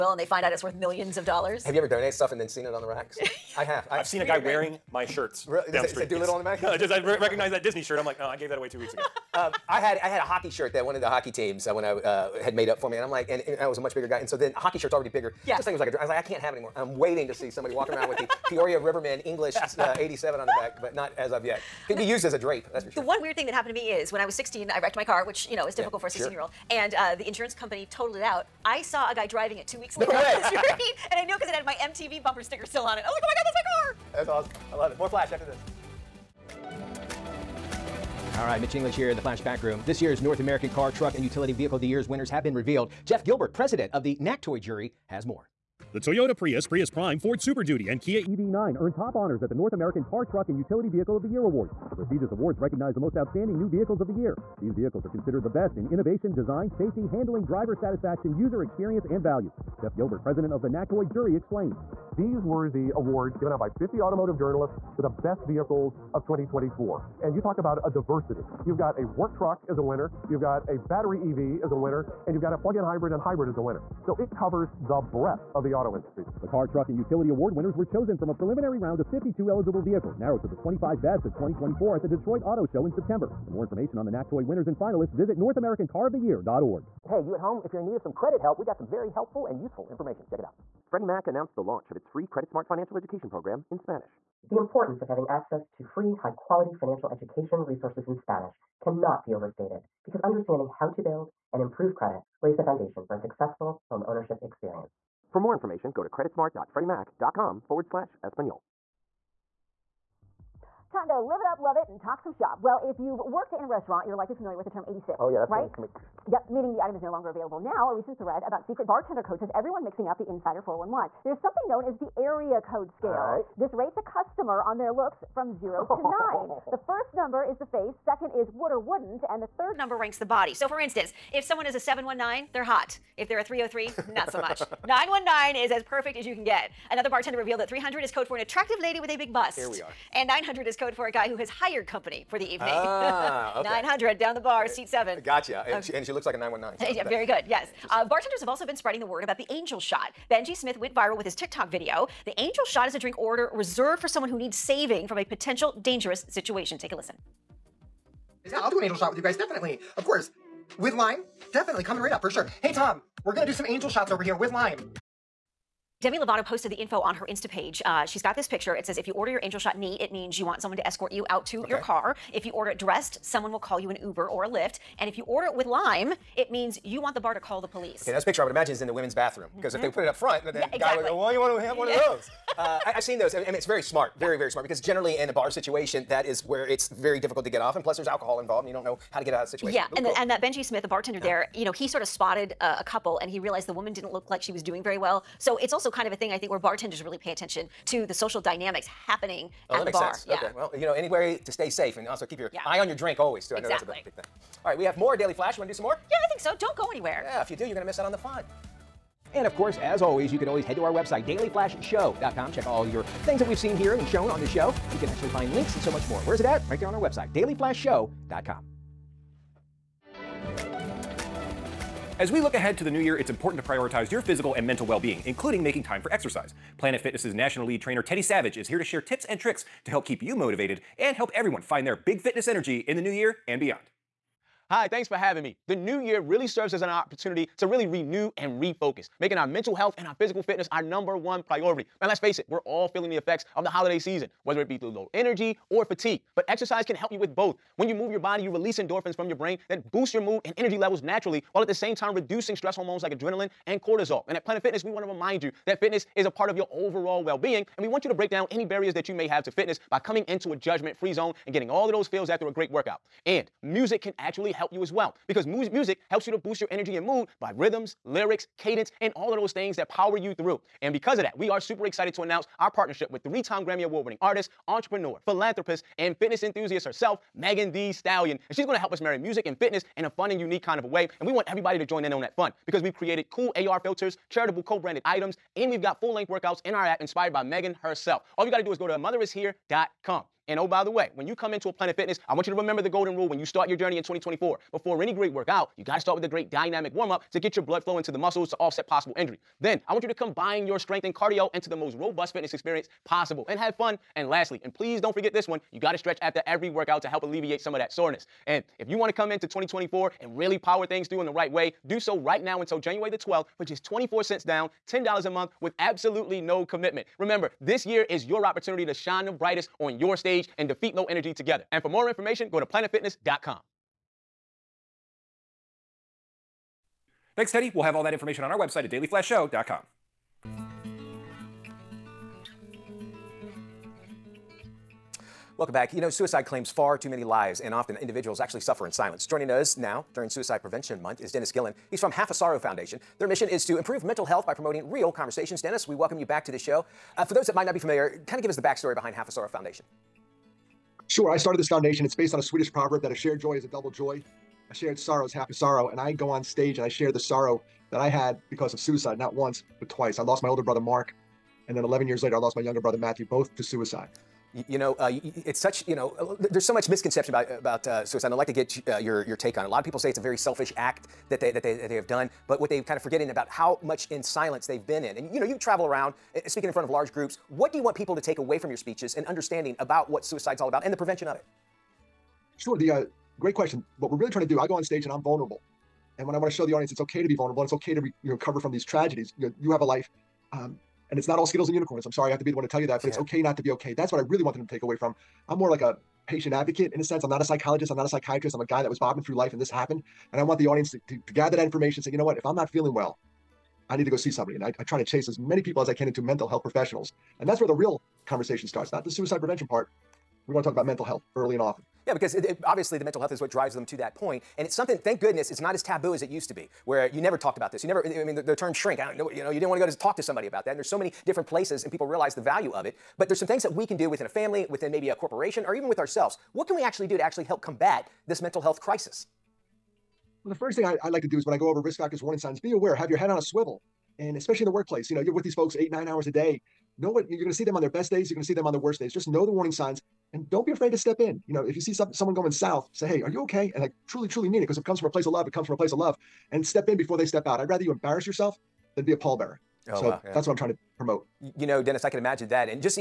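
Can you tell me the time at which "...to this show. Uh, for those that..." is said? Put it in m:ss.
5:46.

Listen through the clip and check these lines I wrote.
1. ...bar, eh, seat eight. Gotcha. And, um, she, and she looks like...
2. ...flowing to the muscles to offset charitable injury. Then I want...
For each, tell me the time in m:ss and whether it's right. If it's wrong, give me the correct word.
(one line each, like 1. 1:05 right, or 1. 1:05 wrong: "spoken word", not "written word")
1. 2:24 wrong: "seven", not "eight"
2. 4:57 wrong: "possible", not "charitable".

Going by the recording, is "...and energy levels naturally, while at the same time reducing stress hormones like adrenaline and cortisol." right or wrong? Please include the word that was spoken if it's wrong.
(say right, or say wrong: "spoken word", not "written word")
right.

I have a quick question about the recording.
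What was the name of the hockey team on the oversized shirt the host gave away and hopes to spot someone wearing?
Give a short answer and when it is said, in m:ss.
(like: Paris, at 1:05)
Peoria Rivermen, at 0:18.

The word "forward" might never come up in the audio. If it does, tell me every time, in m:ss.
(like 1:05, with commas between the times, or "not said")
1:47.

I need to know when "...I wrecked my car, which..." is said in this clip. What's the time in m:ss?
0:24.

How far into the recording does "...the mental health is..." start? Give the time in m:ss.
6:52.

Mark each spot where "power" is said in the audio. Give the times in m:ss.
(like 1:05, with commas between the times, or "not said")
4:29, 5:10.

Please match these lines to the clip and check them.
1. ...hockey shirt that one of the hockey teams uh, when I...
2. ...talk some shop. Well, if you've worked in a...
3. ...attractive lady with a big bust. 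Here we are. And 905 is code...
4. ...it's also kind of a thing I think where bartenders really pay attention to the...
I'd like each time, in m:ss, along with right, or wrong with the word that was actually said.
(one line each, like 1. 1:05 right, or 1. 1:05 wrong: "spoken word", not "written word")
1. 0:10 right
2. 1:51 right
3. 2:18 wrong: "900", not "905"
4. 3:15 right.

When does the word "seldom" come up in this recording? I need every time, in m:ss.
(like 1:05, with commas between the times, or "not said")
not said.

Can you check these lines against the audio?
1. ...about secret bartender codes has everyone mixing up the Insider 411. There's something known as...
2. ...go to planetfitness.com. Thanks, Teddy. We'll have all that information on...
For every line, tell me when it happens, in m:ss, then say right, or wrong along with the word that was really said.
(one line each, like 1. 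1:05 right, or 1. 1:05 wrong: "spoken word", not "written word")
1. 1:58 right
2. 5:22 right.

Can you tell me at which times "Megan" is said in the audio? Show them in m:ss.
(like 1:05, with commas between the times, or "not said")
4:37, 4:47.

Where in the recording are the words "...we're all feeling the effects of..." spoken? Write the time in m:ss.
4:02.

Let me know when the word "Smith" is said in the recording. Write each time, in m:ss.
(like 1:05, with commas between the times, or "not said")
2:30, 3:10.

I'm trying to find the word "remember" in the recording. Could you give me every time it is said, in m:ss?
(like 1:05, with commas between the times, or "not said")
4:52, 5:17.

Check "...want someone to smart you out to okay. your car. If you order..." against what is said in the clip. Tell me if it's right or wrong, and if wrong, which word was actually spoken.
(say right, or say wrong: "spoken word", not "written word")
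wrong: "escort", not "smart".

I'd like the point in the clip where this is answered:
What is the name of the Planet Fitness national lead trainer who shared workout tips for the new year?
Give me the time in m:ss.
3:48.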